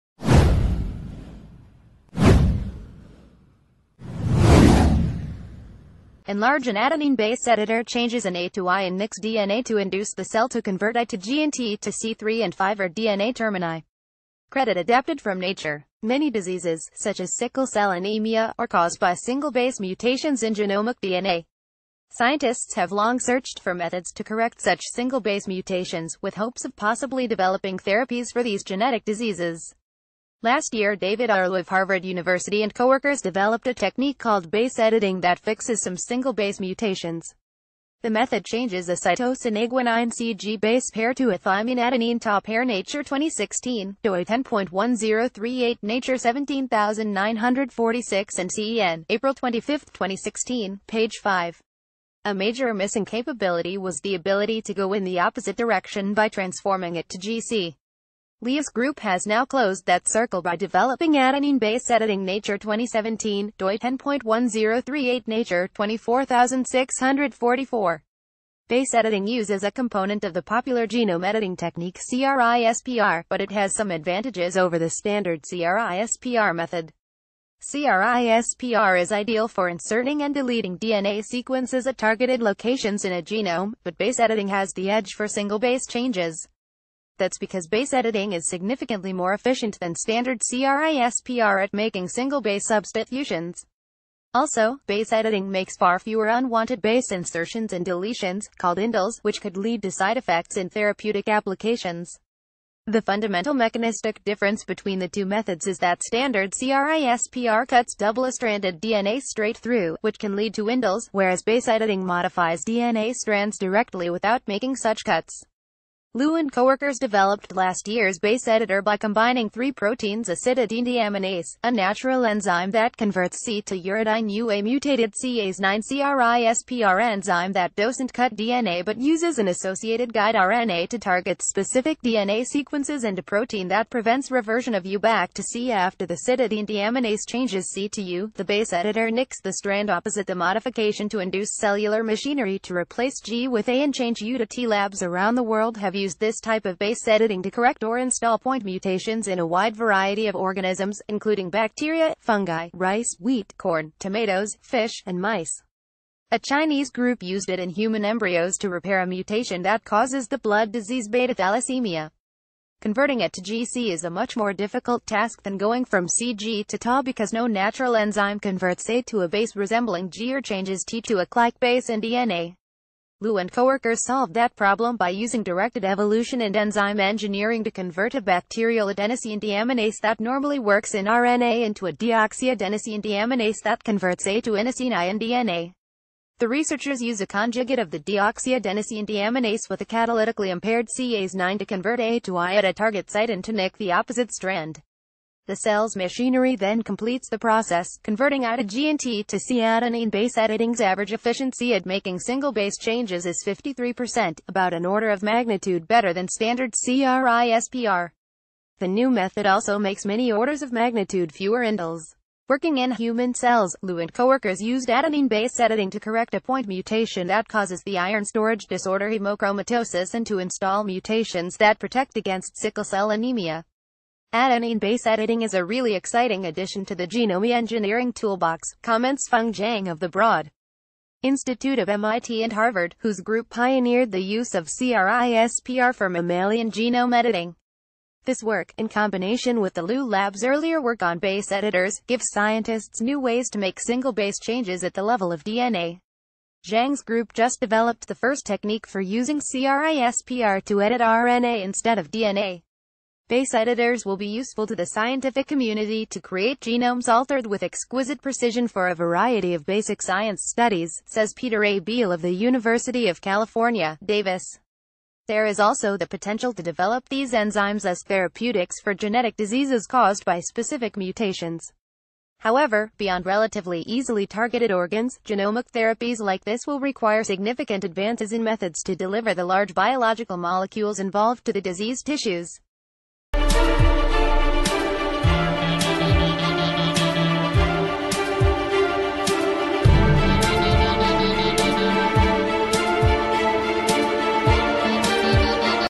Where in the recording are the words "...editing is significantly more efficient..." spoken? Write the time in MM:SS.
01:27.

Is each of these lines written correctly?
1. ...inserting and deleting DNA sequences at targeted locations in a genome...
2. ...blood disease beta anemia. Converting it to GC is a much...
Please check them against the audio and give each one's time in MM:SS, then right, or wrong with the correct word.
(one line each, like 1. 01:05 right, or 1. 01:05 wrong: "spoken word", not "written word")
1. 01:19 right
2. 02:40 wrong: "thalassemia", not "anemia".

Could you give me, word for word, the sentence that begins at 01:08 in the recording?
Base editing uses a component of the popular genome editing technique CRISPR, but it has some advantages over the standard CRISPR method.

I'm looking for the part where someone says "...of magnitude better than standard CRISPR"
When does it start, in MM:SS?
03:25.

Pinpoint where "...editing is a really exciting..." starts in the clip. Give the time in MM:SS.
03:45.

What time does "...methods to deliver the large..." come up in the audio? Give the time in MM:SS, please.
04:38.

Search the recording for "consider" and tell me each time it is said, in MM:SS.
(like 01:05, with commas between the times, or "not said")
not said.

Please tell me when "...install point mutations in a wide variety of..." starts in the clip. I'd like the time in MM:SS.
02:27.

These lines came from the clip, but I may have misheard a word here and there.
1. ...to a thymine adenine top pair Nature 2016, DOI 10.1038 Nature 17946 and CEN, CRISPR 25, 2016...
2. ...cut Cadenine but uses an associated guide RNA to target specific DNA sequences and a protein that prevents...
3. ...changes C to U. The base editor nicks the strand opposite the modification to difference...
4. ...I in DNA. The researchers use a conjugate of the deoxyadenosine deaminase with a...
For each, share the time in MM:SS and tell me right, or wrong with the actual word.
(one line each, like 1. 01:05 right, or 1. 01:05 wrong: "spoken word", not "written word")
1. 00:41 wrong: "April", not "CRISPR"
2. 02:08 wrong: "DNA", not "Cadenine"
3. 02:17 wrong: "induce", not "difference"
4. 03:04 right.